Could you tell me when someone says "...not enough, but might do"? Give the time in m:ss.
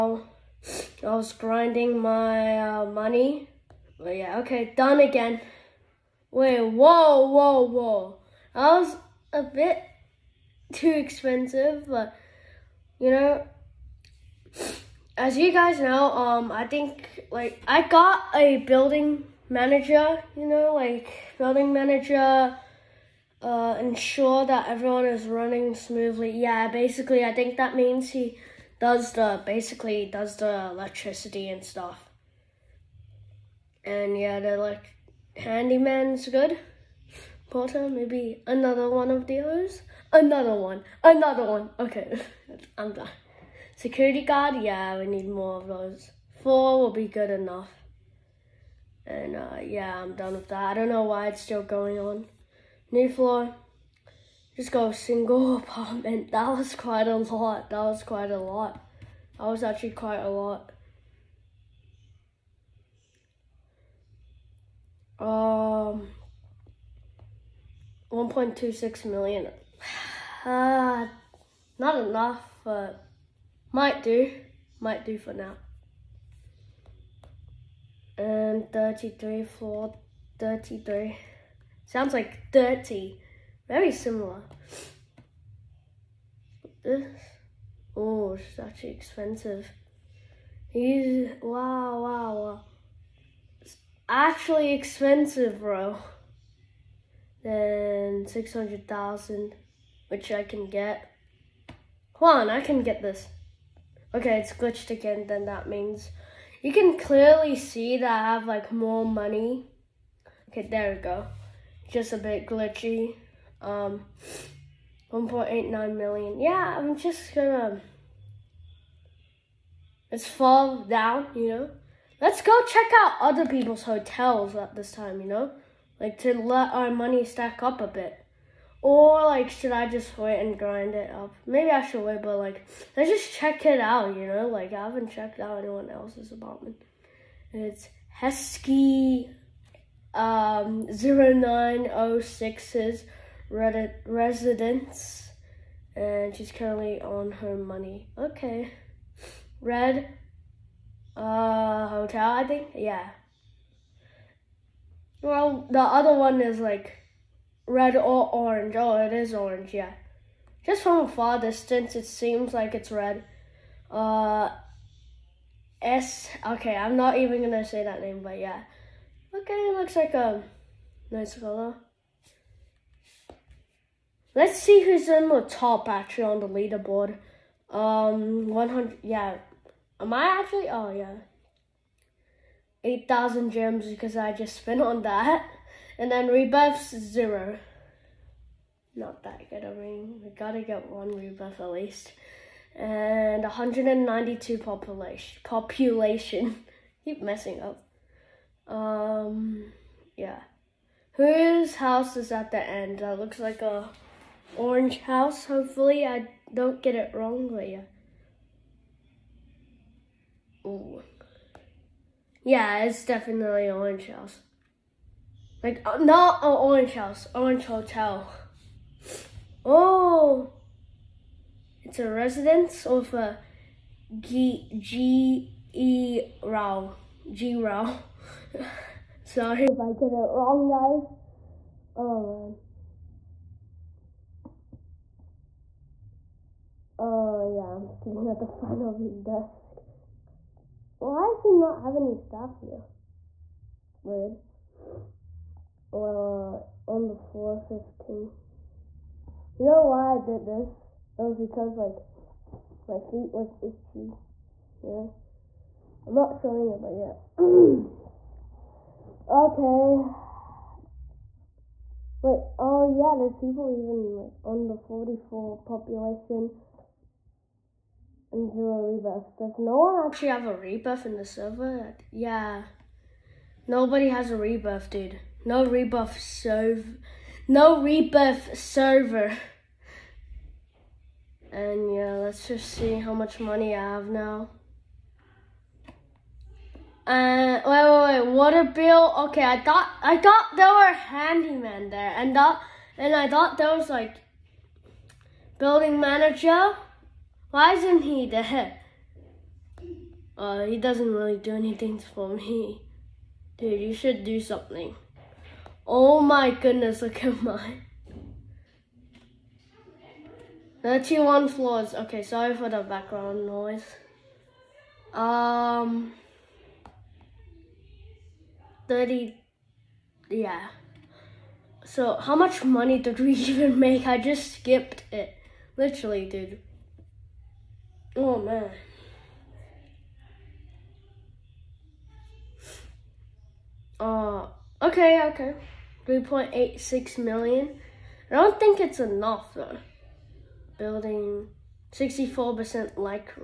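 1:11.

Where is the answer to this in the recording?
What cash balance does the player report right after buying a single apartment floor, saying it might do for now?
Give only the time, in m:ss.
1:08.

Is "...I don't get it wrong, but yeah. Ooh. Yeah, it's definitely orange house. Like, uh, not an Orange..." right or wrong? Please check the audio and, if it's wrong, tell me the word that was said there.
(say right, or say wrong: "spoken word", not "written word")
right.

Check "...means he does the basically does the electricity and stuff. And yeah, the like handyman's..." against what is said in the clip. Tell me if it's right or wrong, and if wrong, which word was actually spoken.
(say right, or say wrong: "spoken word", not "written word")
right.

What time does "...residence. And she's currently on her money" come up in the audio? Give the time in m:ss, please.
2:24.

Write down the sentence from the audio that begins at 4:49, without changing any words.
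Okay, I thought I thought there were handyman there, and that and I thought there was like building manager.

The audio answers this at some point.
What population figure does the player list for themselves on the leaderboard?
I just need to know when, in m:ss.
3:13.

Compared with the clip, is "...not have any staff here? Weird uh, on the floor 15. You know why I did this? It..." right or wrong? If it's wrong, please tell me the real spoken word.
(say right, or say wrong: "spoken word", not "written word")
right.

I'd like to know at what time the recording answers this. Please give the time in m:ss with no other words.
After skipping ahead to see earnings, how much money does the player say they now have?
5:36.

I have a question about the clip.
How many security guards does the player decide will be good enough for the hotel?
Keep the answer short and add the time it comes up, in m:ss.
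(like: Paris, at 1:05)
4, at 0:46.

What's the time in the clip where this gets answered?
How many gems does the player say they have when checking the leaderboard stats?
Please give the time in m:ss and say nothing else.
3:02.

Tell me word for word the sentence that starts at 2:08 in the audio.
Or like, should I just wait and grind it up?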